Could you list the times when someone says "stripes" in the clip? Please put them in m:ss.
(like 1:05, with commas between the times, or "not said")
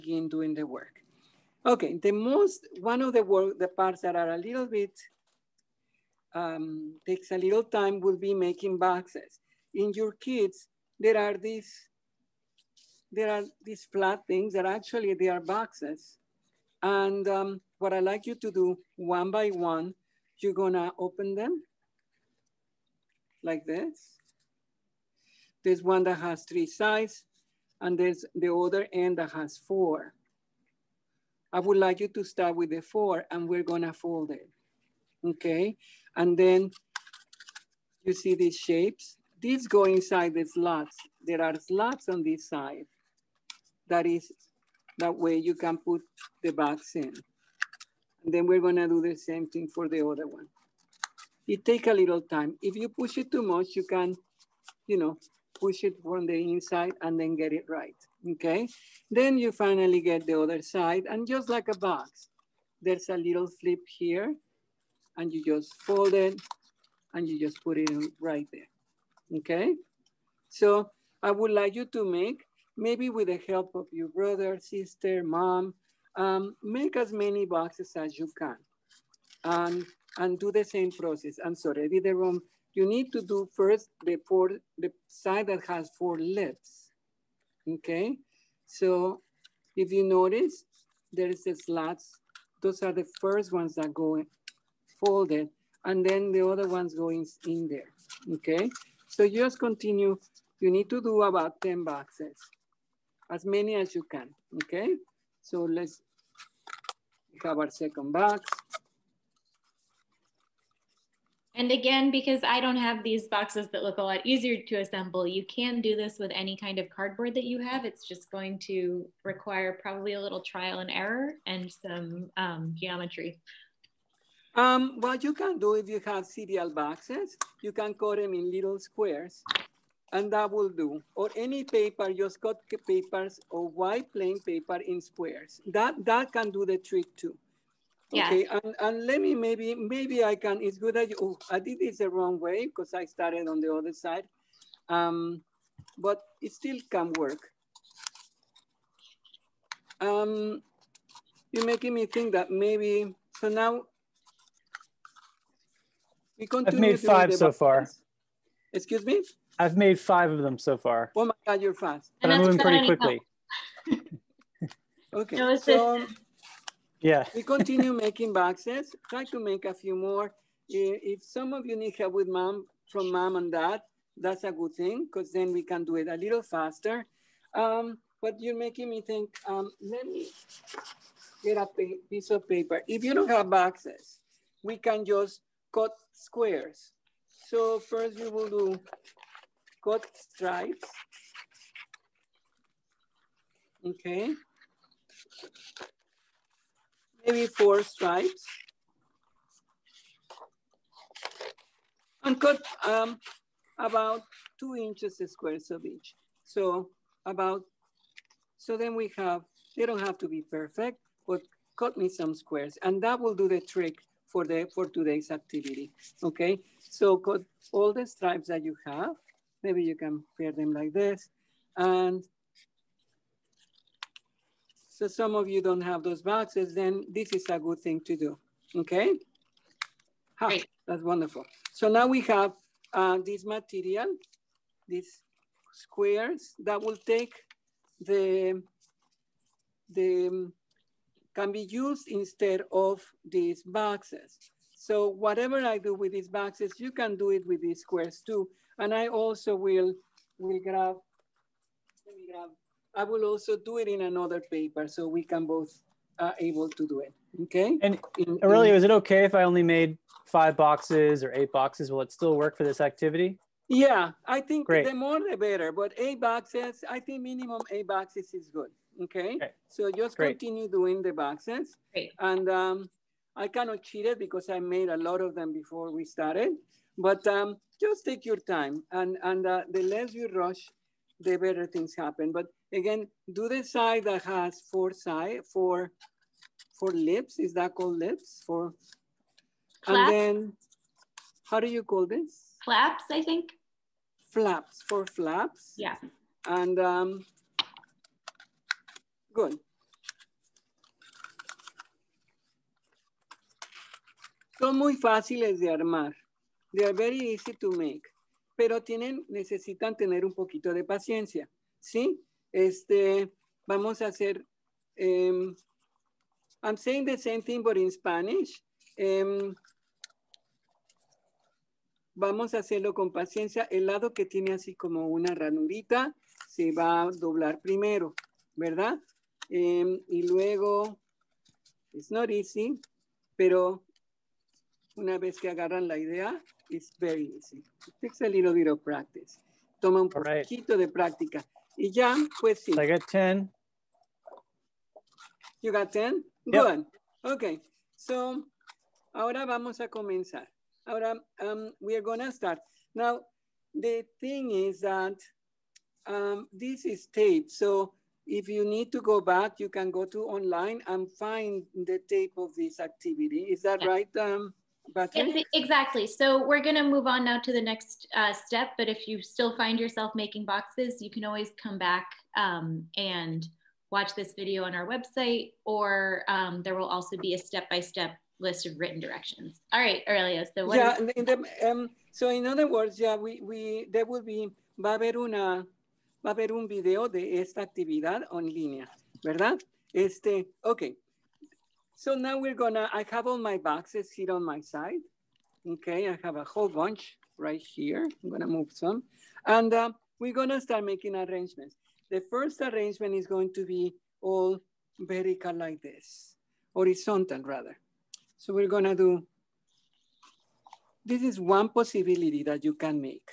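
3:10, 3:17, 3:38.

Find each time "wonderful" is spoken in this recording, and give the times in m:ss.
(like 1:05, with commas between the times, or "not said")
3:51.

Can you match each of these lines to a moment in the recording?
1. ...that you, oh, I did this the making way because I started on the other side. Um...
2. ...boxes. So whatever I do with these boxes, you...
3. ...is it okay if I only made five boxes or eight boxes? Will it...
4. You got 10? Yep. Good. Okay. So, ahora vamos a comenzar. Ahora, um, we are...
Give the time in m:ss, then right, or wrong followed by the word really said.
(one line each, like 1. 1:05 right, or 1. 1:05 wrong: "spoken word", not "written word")
1. 2:20 wrong: "wrong", not "making"
2. 4:03 right
3. 4:18 right
4. 5:45 right.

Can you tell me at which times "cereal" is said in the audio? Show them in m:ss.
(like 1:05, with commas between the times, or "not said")
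2:06.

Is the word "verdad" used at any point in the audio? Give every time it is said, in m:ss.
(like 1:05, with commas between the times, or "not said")
5:28, 6:29.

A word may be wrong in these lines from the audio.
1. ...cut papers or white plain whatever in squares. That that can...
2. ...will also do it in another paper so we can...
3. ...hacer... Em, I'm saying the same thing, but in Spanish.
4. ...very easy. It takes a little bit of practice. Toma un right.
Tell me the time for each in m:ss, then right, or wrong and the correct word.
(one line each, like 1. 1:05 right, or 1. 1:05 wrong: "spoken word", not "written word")
1. 2:12 wrong: "paper", not "whatever"
2. 4:13 right
3. 5:14 right
4. 5:36 right.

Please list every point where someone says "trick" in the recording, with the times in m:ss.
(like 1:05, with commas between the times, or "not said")
2:16, 3:33.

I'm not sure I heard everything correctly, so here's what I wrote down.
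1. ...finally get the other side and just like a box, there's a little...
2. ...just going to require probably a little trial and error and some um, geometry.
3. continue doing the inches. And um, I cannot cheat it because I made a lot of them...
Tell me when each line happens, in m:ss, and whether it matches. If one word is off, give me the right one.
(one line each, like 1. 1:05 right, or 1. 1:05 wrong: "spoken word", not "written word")
1. 0:59 right
2. 1:58 right
3. 4:30 wrong: "boxes", not "inches".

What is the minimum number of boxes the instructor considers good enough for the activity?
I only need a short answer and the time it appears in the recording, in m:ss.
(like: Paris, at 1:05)
8, at 4:27.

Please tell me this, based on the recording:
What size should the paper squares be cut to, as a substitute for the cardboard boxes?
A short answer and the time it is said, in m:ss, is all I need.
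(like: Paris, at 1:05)
2 inches, at 3:23.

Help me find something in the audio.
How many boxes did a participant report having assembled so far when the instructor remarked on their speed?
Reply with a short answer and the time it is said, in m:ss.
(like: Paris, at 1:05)
5, at 2:39.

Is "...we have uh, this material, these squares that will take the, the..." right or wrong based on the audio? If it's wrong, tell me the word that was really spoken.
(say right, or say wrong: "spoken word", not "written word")
right.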